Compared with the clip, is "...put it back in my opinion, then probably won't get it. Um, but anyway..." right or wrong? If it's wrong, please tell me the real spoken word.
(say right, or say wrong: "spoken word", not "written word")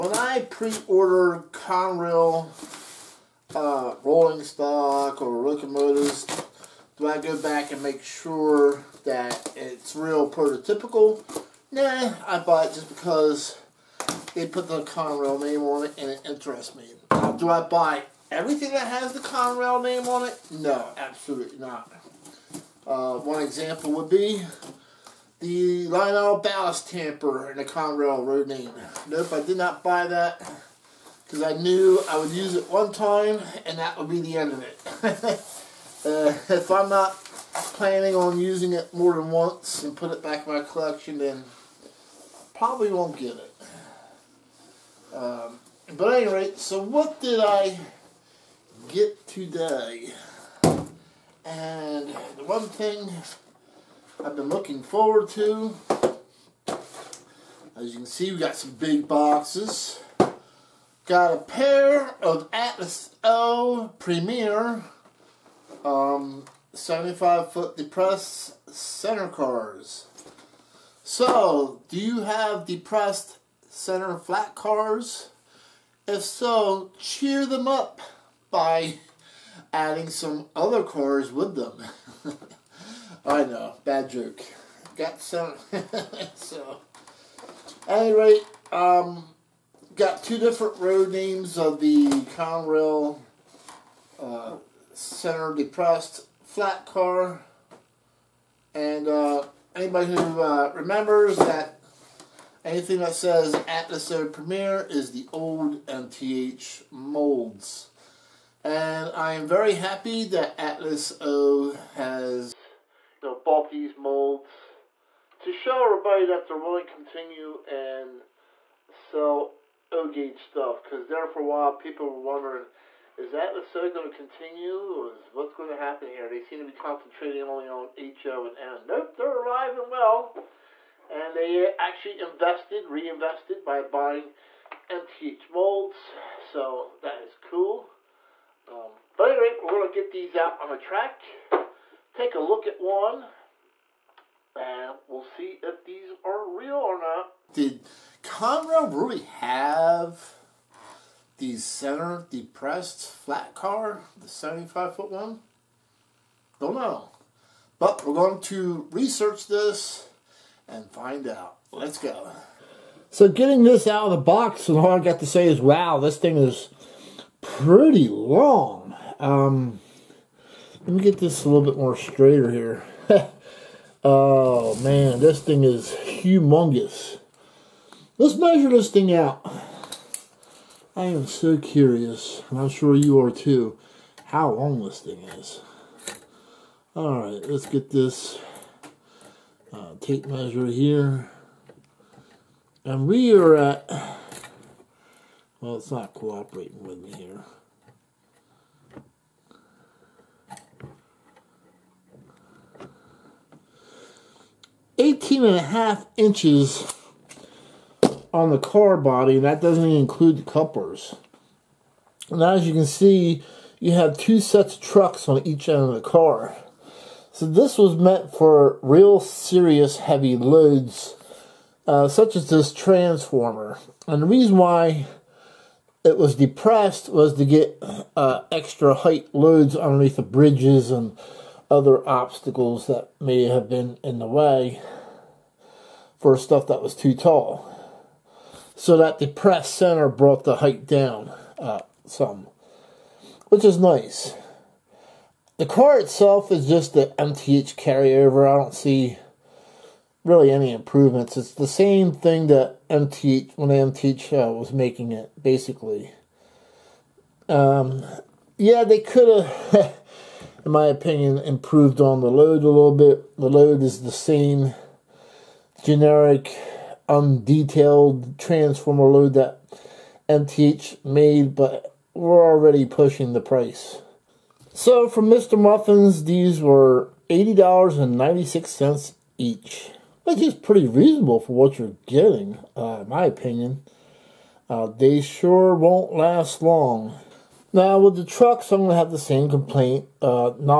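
wrong: "collection", not "opinion".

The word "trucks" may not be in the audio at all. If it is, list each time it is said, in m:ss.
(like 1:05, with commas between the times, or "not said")
3:34, 4:48.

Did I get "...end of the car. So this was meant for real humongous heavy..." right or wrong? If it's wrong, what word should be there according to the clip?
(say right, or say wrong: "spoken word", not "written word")
wrong: "serious", not "humongous".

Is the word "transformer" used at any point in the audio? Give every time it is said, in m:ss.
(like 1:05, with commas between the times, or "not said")
3:42, 4:28.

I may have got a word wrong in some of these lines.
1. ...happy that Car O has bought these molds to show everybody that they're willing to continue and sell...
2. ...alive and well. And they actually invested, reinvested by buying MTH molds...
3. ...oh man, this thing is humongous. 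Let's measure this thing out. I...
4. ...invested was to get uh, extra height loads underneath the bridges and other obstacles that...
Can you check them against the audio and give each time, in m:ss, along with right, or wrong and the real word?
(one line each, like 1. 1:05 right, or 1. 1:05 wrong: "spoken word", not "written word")
1. 1:49 wrong: "Atlas", not "Car"
2. 2:09 right
3. 2:54 right
4. 3:46 wrong: "depressed", not "invested".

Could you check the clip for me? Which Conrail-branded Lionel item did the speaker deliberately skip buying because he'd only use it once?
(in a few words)
ballast tamper.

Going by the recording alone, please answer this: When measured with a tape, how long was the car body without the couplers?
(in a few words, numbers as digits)
18.5 inches.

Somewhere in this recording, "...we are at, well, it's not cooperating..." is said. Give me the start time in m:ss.
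3:13.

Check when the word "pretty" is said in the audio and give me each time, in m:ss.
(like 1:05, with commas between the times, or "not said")
2:47, 4:40.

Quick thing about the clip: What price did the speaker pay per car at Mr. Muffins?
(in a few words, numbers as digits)
$80.96.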